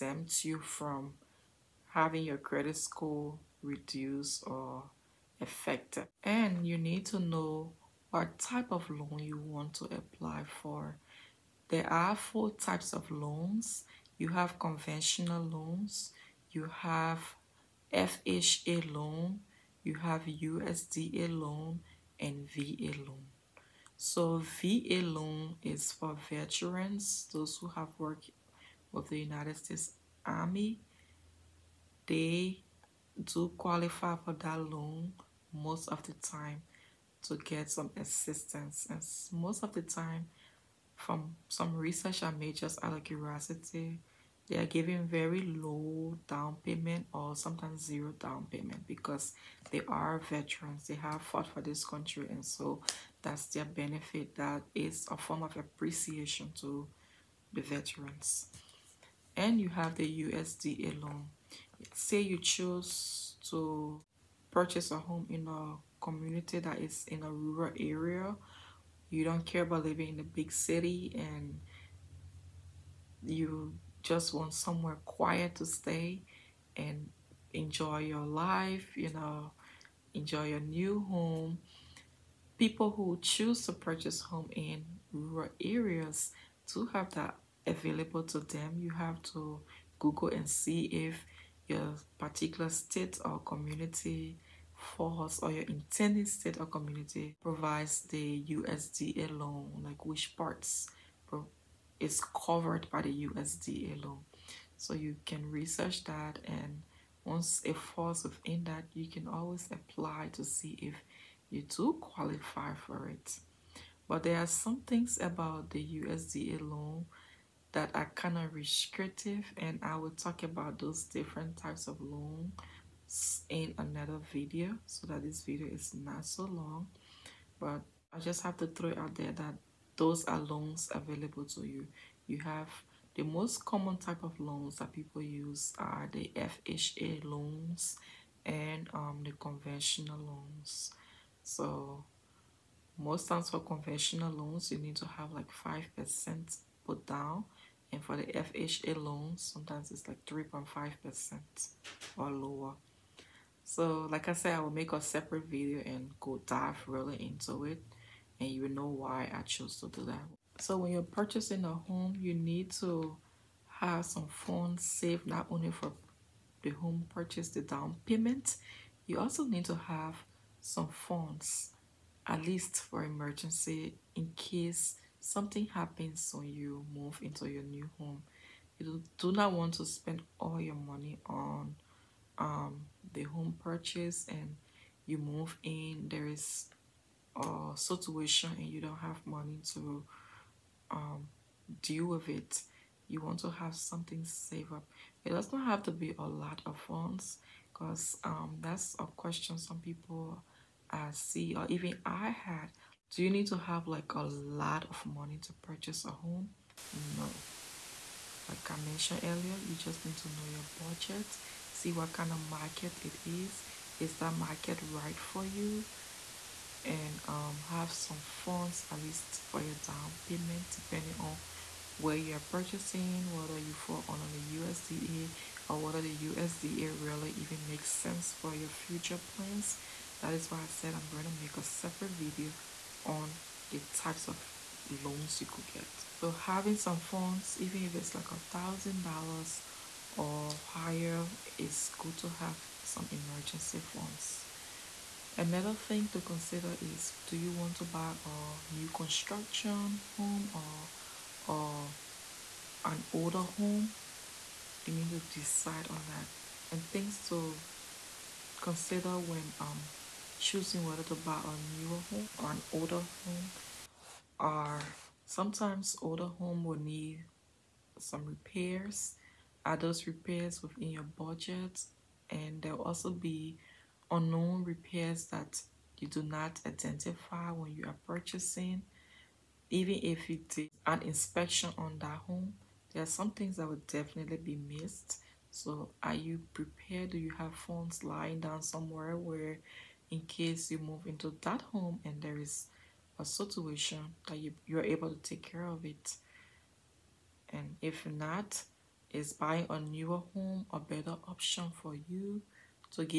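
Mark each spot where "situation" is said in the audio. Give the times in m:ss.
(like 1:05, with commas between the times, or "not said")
3:07, 4:53.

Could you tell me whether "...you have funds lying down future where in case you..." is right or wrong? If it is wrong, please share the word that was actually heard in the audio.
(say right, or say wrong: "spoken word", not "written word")
wrong: "somewhere", not "future".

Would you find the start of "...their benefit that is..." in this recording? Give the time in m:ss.
0:53.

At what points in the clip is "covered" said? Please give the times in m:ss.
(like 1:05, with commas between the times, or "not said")
1:42.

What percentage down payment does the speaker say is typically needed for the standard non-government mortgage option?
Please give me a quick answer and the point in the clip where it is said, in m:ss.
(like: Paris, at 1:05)
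5%, at 2:25.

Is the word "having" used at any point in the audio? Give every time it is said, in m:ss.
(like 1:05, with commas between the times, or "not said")
0:01, 3:56.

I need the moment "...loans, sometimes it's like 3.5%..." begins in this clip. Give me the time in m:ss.
2:29.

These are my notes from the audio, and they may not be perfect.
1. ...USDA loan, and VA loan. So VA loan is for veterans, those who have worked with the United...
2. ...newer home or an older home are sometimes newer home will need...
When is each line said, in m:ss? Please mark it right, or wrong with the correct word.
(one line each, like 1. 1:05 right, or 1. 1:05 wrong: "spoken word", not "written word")
1. 0:20 right
2. 4:21 wrong: "older", not "newer".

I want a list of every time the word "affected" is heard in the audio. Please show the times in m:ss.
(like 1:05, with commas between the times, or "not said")
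0:05.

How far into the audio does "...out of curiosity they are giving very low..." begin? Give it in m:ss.
0:42.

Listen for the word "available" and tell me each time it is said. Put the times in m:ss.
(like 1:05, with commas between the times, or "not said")
1:27, 2:10.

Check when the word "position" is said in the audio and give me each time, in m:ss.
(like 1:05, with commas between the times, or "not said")
not said.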